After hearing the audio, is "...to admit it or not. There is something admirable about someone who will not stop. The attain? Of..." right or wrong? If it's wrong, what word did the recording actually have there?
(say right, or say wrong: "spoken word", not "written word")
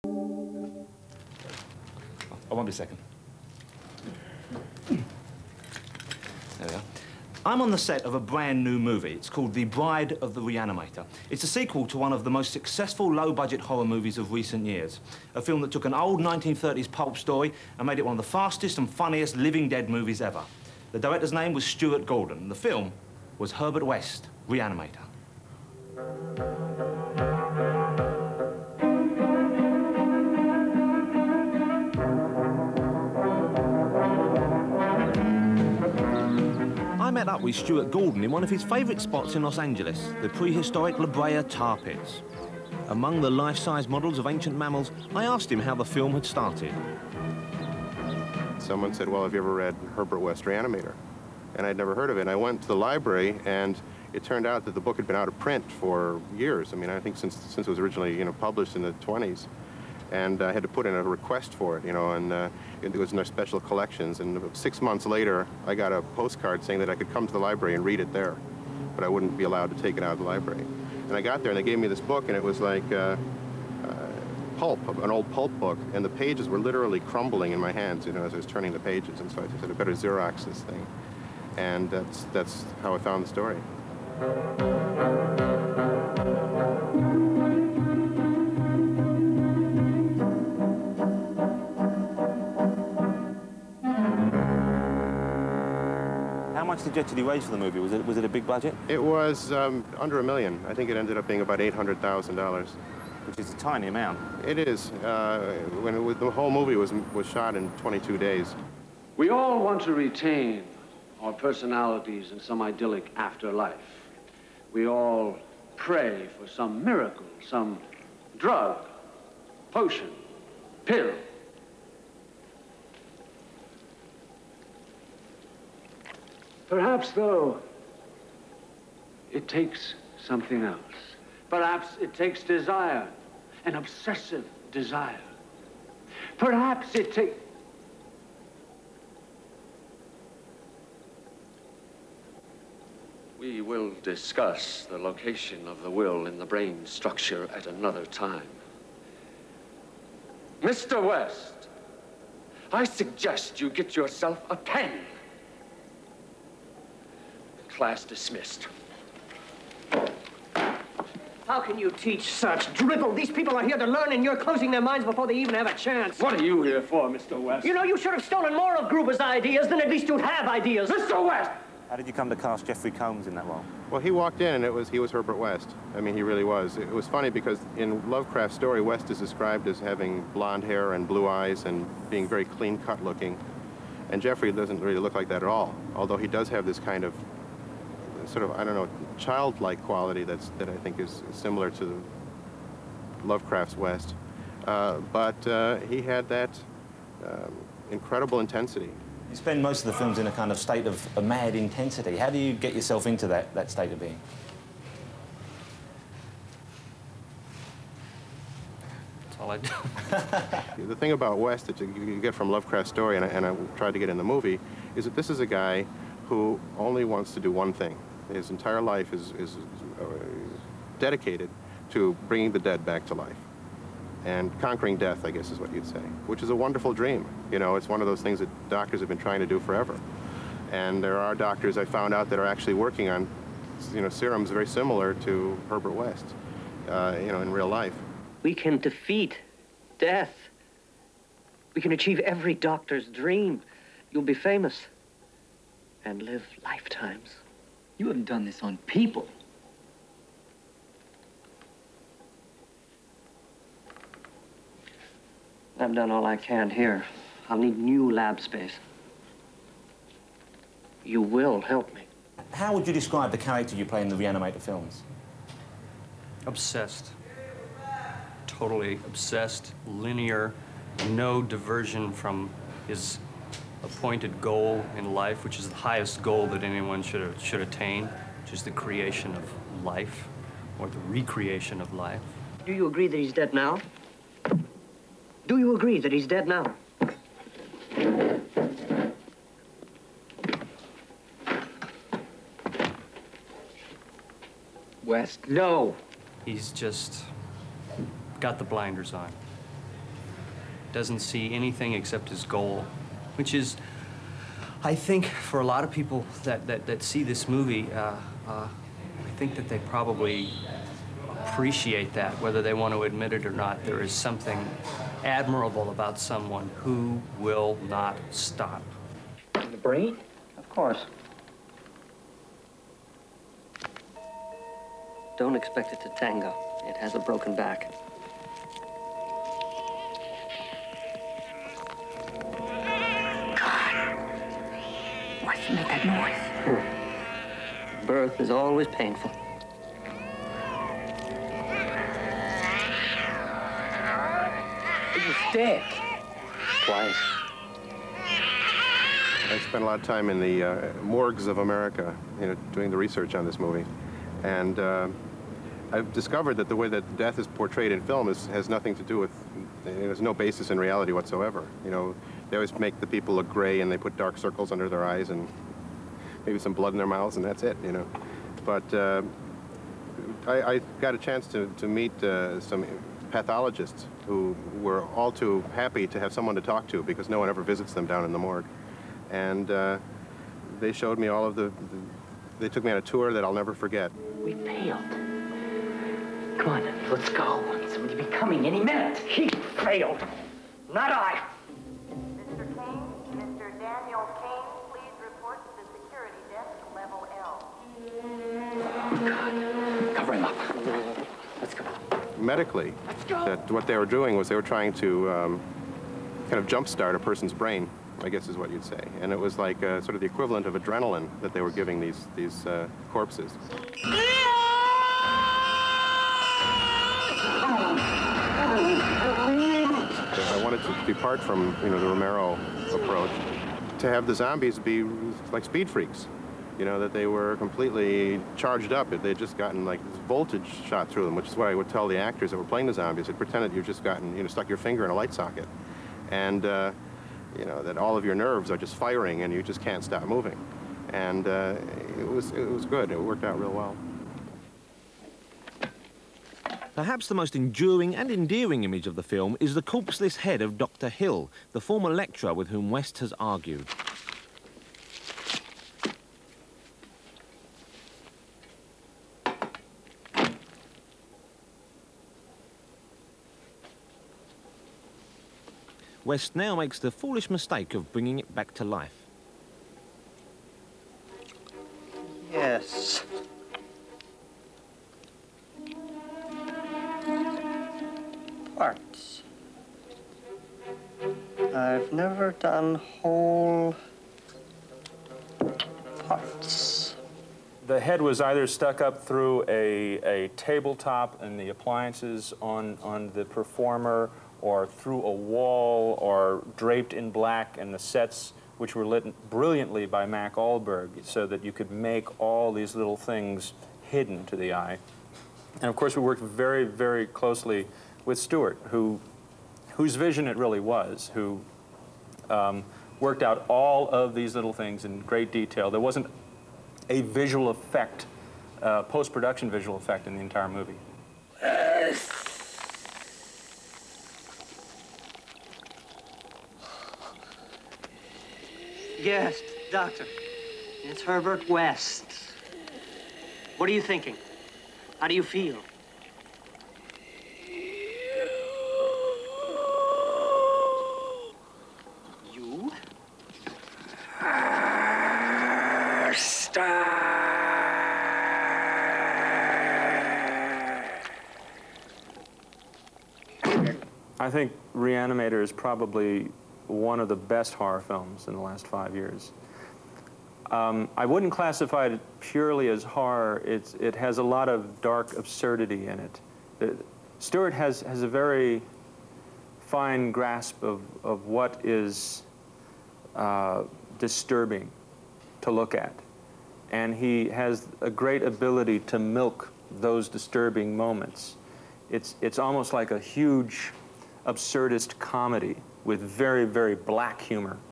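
wrong: "brain", not "attain".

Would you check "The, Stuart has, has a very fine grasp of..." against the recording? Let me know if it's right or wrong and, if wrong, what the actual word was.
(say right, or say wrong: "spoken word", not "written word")
right.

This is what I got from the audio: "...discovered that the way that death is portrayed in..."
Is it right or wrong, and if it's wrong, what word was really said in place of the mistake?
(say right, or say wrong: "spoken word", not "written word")
right.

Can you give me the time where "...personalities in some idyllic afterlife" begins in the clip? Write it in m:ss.
1:51.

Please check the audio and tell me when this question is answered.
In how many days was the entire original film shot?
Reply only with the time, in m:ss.
1:47.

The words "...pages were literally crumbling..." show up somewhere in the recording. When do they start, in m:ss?
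1:16.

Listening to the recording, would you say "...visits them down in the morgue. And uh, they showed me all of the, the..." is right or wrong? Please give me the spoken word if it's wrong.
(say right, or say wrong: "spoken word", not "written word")
right.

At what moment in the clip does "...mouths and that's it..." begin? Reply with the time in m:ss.
6:07.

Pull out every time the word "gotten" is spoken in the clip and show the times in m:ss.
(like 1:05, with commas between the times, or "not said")
7:09, 7:14.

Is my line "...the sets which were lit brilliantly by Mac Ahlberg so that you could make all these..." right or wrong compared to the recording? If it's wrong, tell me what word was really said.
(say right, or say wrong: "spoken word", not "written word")
right.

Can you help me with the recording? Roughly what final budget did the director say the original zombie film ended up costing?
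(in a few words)
$800,000.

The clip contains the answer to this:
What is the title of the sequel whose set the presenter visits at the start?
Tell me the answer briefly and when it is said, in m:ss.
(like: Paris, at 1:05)
The Bride of the Reanimator, at 0:09.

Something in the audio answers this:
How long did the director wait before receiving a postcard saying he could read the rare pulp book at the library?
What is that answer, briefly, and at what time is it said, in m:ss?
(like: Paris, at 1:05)
6 months, at 1:04.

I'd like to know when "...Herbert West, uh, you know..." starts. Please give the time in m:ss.
3:55.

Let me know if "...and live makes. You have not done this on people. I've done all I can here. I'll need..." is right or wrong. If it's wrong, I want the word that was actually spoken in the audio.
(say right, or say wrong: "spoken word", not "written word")
wrong: "lifetimes", not "makes".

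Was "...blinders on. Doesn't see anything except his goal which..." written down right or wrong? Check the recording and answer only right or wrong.
right.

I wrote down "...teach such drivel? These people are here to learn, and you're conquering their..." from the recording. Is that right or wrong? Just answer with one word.
wrong.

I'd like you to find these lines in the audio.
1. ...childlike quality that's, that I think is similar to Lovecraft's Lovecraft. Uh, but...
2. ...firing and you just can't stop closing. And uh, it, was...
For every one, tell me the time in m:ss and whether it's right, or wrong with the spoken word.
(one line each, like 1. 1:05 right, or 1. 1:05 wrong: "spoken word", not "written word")
1. 3:09 wrong: "West", not "Lovecraft"
2. 7:18 wrong: "moving", not "closing".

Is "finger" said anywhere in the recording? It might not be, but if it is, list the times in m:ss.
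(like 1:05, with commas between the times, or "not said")
7:14.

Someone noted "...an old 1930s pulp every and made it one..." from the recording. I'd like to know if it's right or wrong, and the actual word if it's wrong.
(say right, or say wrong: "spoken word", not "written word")
wrong: "story", not "every".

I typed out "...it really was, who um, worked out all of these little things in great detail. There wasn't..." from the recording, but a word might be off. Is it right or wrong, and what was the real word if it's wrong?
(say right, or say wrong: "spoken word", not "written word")
right.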